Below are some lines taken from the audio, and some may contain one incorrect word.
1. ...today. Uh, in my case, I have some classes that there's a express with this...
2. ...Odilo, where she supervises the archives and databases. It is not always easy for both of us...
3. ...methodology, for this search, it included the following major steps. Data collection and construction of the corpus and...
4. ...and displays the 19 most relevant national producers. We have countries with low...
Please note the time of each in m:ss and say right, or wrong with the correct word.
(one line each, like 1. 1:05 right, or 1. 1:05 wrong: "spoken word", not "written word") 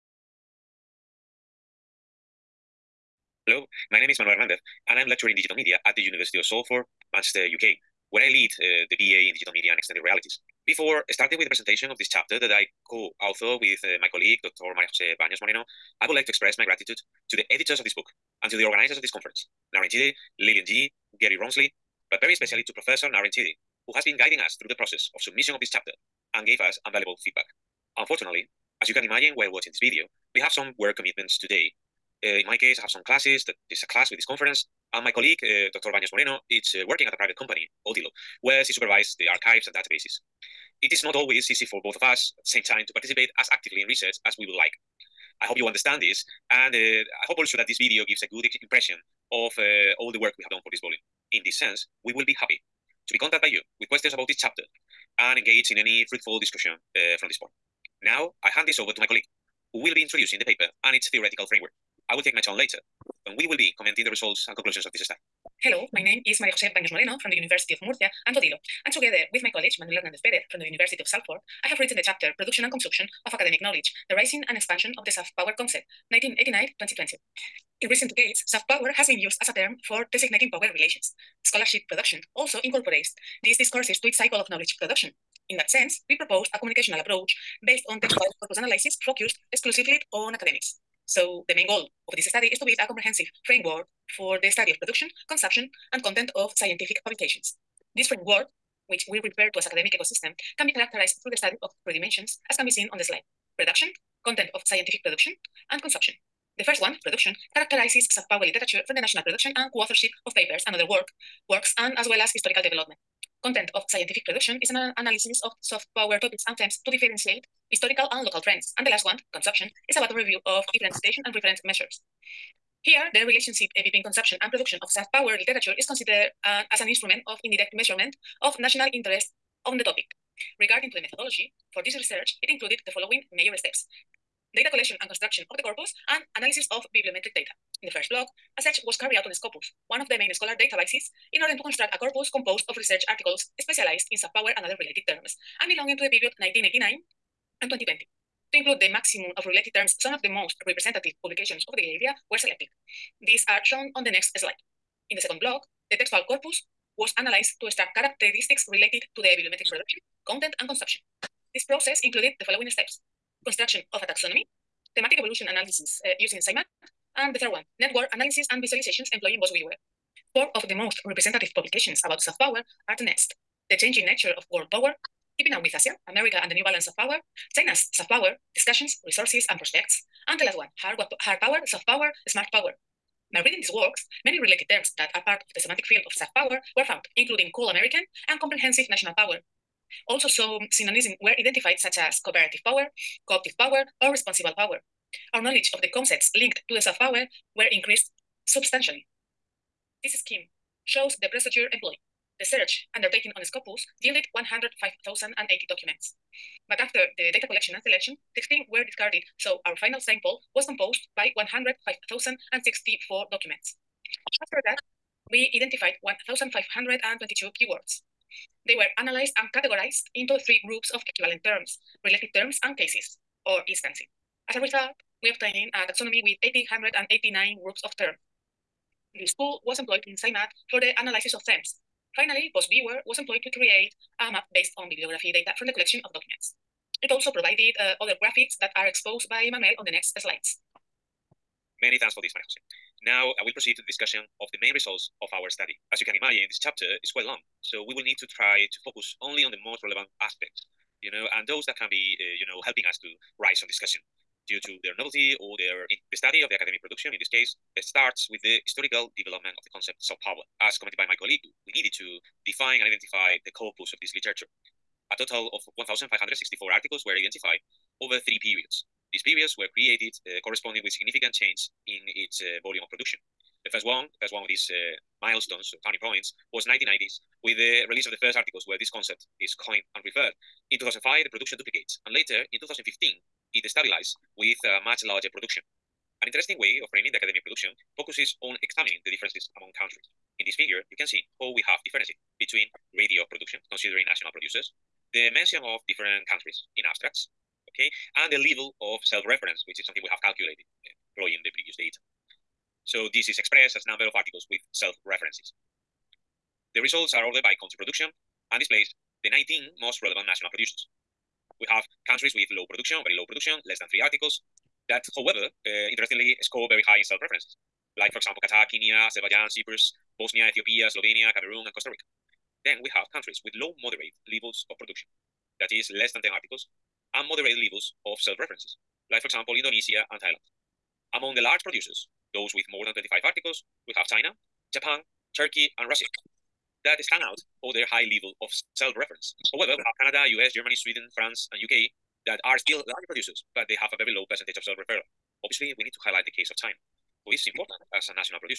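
1. 0:31 wrong: "class", not "express"
2. 0:37 right
3. 2:11 wrong: "research", not "search"
4. 5:08 right.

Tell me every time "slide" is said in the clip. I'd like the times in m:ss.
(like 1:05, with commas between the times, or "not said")
1:43, 2:34, 4:00.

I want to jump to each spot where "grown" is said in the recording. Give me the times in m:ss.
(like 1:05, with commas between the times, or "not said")
not said.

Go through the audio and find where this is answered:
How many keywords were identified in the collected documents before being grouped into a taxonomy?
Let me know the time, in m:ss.
3:36.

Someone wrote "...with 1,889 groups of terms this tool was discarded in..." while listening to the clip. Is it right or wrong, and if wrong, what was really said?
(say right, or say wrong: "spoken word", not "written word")
wrong: "employed", not "discarded".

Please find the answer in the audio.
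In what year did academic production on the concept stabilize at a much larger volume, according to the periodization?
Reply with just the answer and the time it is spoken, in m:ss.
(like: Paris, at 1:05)
2015, at 4:42.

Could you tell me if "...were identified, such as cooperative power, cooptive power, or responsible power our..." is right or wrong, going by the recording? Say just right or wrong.
right.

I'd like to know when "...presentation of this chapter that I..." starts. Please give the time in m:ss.
0:11.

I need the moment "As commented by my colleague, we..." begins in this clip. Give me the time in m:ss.
4:20.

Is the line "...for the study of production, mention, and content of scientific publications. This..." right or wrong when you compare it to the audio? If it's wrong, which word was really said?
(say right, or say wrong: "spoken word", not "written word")
wrong: "consumption", not "mention".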